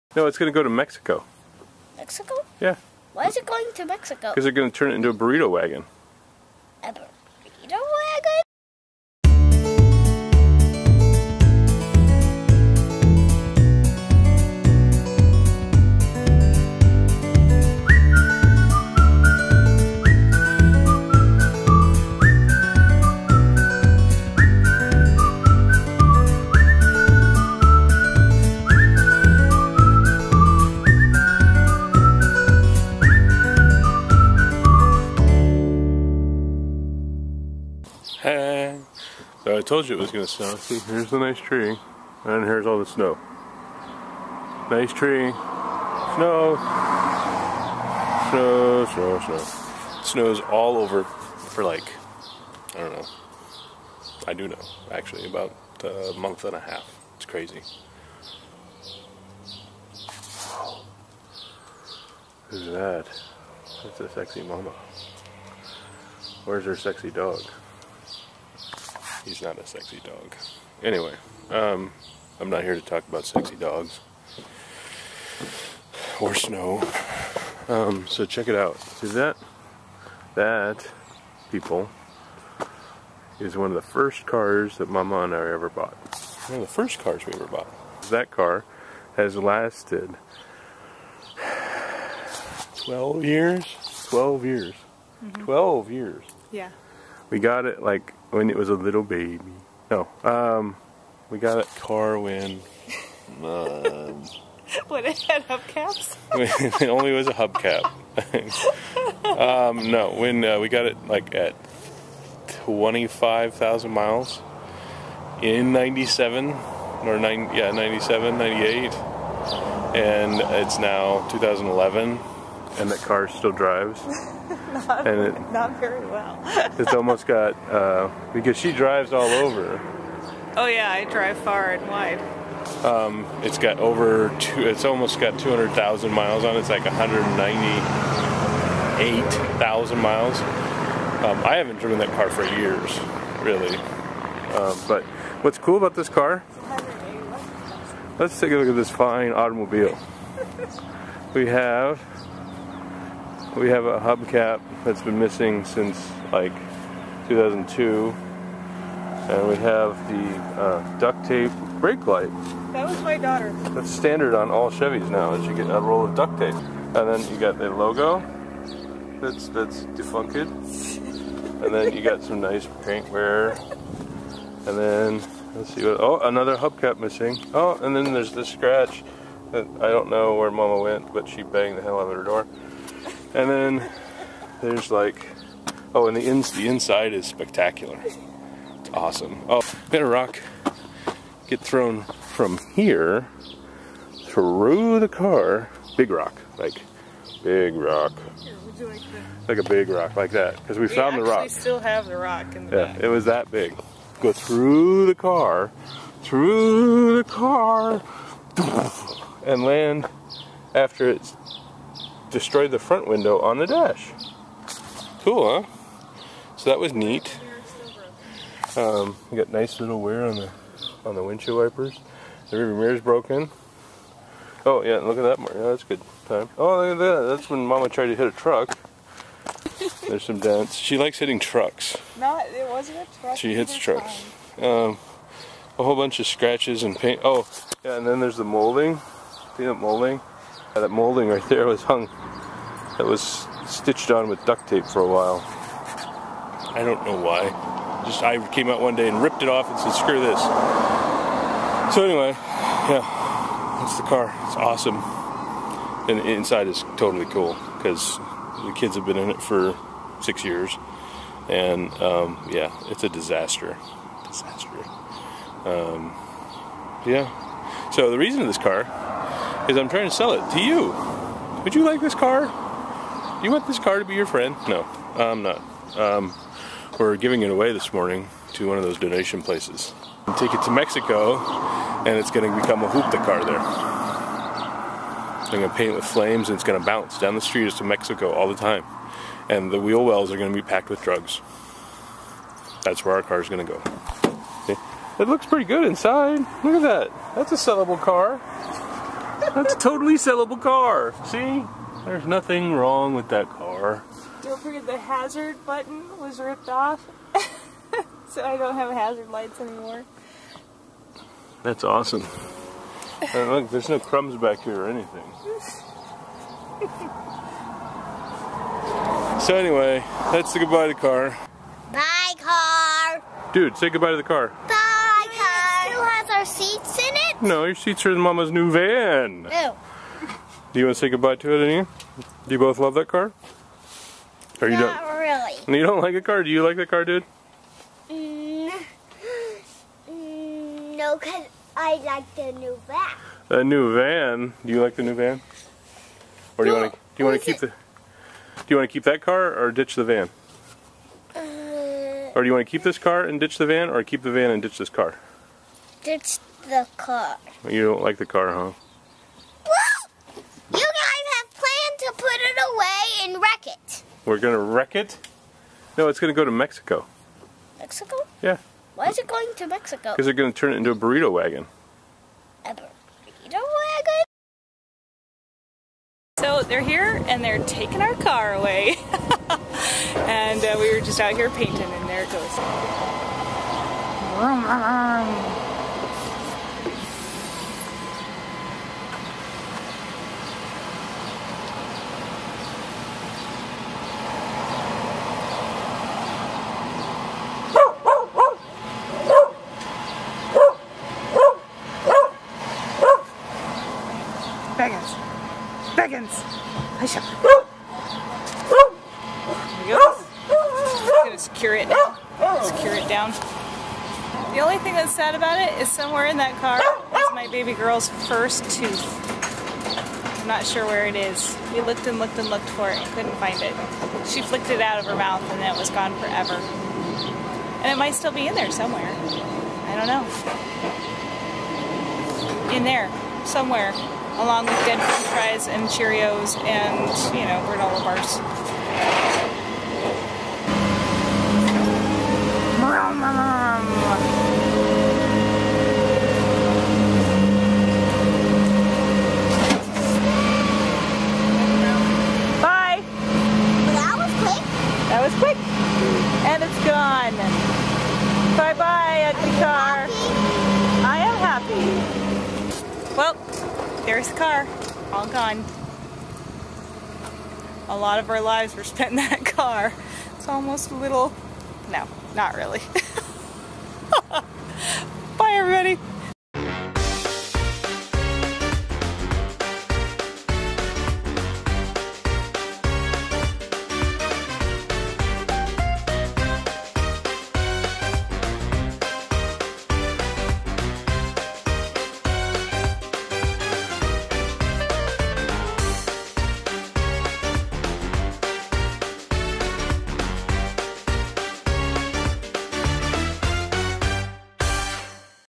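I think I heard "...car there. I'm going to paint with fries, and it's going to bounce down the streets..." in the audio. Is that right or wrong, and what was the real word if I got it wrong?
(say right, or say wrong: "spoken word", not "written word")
wrong: "flames", not "fries".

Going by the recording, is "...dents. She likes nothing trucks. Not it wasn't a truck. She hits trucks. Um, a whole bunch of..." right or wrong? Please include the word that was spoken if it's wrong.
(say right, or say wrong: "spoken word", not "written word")
wrong: "hitting", not "nothing".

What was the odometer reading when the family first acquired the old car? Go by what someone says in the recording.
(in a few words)
25,000 miles.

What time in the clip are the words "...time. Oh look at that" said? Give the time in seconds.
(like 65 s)
226 s.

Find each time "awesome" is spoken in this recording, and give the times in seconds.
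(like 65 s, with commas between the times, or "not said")
188 s, 254 s, 311 s.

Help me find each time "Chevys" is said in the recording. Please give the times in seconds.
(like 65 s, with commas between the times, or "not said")
164 s.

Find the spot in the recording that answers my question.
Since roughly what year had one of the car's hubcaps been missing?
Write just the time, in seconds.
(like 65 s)
155 s.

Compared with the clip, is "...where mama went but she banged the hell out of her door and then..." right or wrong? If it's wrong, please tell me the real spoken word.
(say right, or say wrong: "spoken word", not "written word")
right.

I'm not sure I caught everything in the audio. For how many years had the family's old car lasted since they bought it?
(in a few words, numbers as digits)
12 years.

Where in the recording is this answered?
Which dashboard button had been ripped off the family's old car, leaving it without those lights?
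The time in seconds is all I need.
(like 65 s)
304 s.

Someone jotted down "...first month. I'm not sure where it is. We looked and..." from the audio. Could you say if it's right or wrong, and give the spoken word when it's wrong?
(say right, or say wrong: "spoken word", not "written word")
wrong: "tooth", not "month".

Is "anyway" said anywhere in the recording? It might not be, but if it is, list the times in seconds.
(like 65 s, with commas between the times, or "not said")
70 s, 252 s, 319 s.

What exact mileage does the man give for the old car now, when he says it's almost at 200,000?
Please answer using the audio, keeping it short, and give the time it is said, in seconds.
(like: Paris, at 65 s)
198,000 miles, at 136 s.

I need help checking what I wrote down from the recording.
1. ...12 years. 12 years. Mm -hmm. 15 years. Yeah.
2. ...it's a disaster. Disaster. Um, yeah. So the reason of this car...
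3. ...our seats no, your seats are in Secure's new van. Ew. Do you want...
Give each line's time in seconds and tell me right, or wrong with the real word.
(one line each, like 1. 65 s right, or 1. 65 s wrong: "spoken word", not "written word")
1. 92 s wrong: "12", not "15"
2. 262 s right
3. 326 s wrong: "Mama", not "Secure".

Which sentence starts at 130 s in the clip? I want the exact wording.
Oh yeah, I drive far and wide.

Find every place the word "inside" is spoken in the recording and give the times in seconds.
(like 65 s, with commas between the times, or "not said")
186 s, 256 s, 295 s.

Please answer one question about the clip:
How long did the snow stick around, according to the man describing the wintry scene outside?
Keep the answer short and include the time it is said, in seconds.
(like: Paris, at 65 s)
a month and a half, at 55 s.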